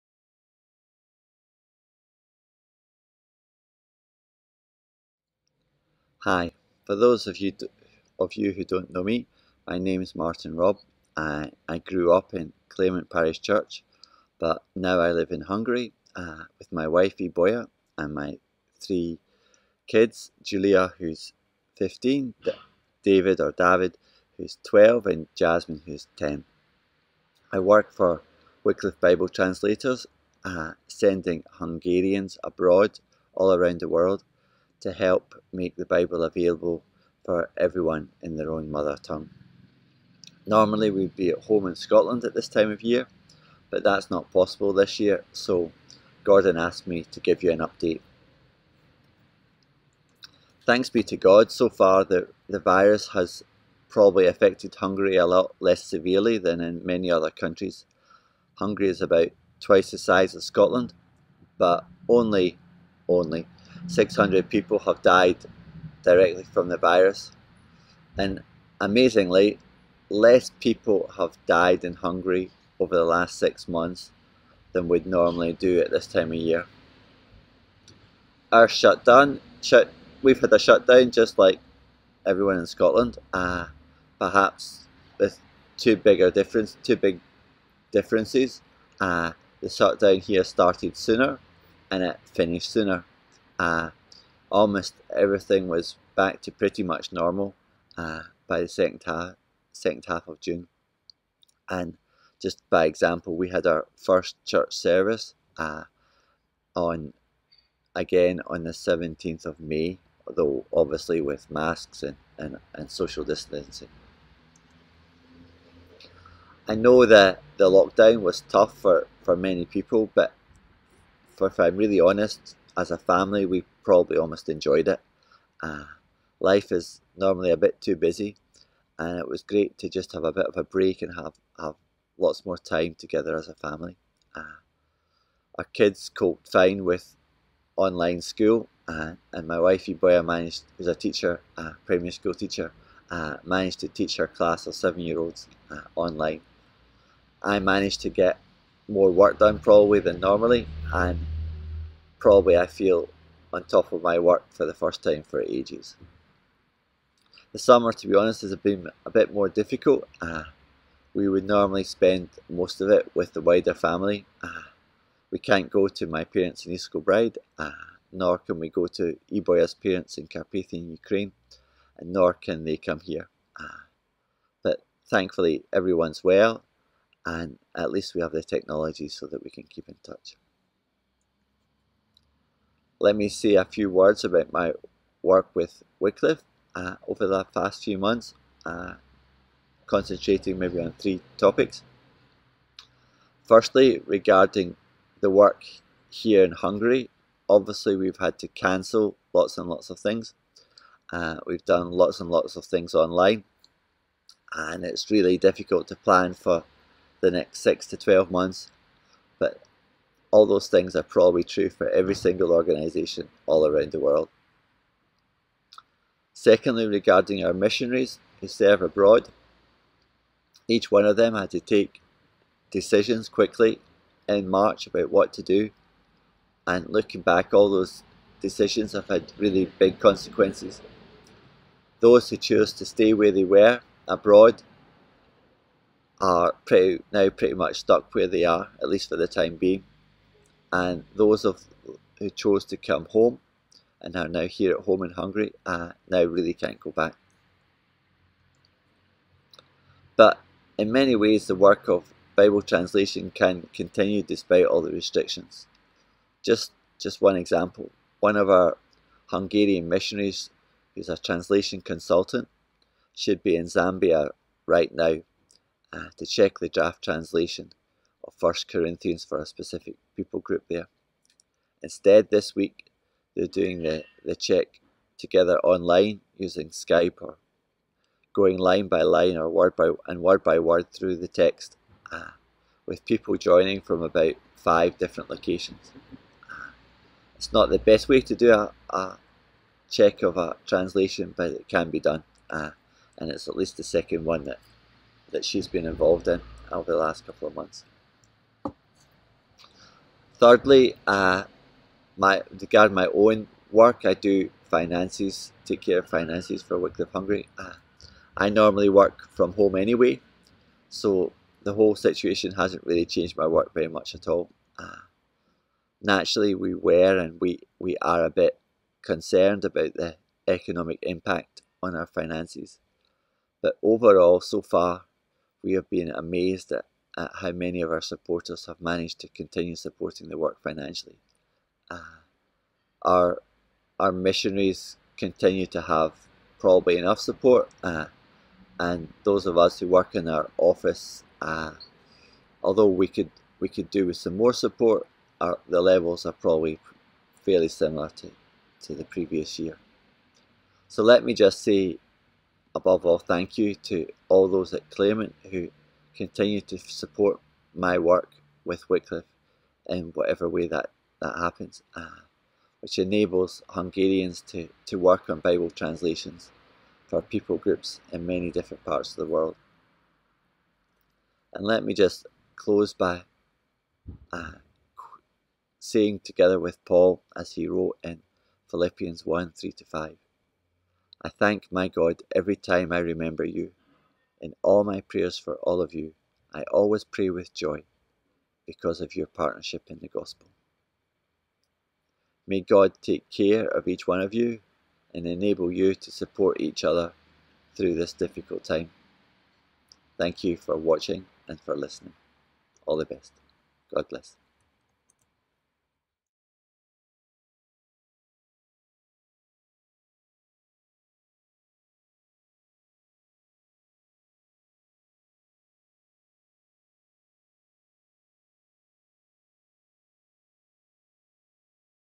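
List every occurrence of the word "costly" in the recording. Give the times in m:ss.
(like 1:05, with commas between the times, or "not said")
not said.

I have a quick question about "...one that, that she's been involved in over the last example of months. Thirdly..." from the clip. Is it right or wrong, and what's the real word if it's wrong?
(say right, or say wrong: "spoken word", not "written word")
wrong: "couple", not "example".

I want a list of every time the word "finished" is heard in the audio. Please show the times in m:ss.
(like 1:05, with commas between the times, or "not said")
1:32.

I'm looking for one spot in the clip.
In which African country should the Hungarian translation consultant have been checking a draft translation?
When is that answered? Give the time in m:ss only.
4:23.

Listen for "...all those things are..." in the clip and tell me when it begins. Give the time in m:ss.
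3:30.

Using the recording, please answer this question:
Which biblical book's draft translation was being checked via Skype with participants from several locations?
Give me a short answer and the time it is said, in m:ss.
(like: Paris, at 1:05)
1 Corinthians, at 4:28.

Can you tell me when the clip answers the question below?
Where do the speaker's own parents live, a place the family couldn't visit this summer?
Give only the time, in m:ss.
2:46.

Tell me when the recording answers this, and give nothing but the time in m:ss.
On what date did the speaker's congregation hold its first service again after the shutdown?
1:48.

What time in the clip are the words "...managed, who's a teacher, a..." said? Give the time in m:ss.
2:20.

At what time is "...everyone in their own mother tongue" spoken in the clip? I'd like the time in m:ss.
0:37.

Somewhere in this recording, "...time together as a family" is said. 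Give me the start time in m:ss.
2:12.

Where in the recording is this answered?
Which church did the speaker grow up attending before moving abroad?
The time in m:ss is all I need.
0:12.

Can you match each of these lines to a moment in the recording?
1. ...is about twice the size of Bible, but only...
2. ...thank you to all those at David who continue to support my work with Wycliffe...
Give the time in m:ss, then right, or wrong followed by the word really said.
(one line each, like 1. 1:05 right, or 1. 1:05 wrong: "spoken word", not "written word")
1. 0:58 wrong: "Scotland", not "Bible"
2. 5:53 wrong: "Claremont", not "David".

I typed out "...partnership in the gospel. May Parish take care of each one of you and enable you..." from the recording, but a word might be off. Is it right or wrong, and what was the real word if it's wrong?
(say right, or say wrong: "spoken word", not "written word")
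wrong: "God", not "Parish".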